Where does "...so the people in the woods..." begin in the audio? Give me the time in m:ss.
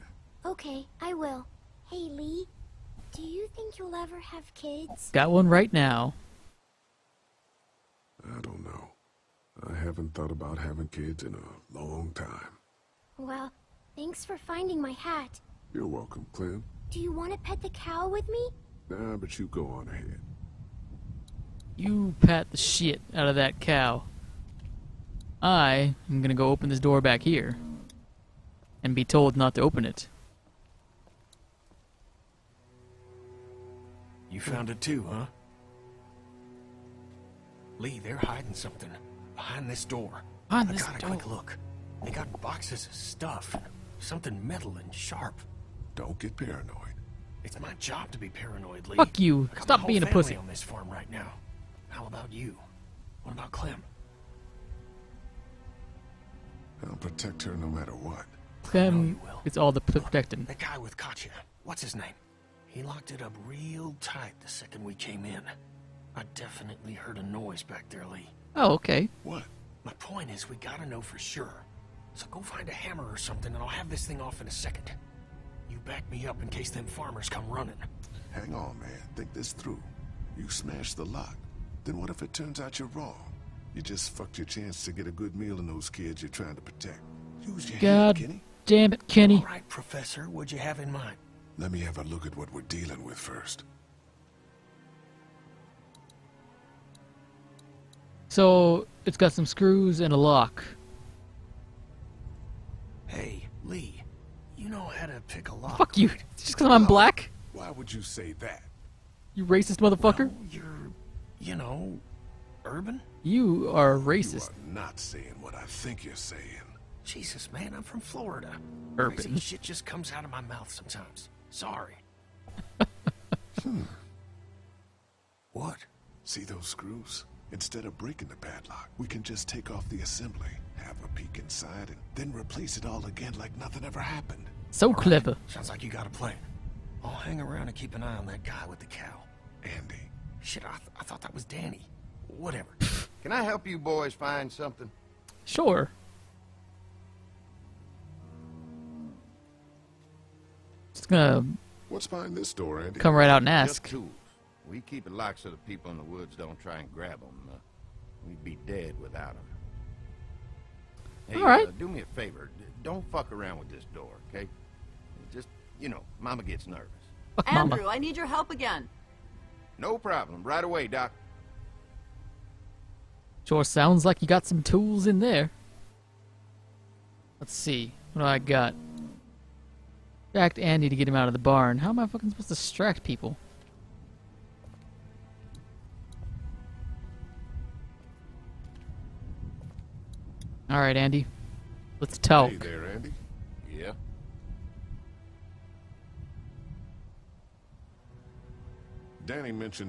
2:35.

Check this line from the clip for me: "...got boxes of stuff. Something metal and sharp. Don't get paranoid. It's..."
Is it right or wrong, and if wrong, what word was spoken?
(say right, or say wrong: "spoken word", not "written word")
right.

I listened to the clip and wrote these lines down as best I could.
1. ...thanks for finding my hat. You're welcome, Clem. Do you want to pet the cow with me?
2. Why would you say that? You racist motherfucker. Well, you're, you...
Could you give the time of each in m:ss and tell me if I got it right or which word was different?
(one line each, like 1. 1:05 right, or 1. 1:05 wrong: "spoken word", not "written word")
1. 0:13 right
2. 1:47 right.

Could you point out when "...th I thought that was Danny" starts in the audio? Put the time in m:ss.
2:20.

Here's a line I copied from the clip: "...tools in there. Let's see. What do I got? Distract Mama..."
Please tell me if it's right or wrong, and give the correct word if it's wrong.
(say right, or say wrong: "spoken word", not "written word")
wrong: "Andy", not "Mama".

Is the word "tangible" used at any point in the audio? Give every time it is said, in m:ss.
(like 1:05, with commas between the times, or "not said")
not said.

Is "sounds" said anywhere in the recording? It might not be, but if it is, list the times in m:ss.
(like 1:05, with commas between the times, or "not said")
2:15, 2:53.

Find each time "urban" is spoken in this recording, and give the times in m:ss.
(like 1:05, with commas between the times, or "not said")
1:52, 1:58.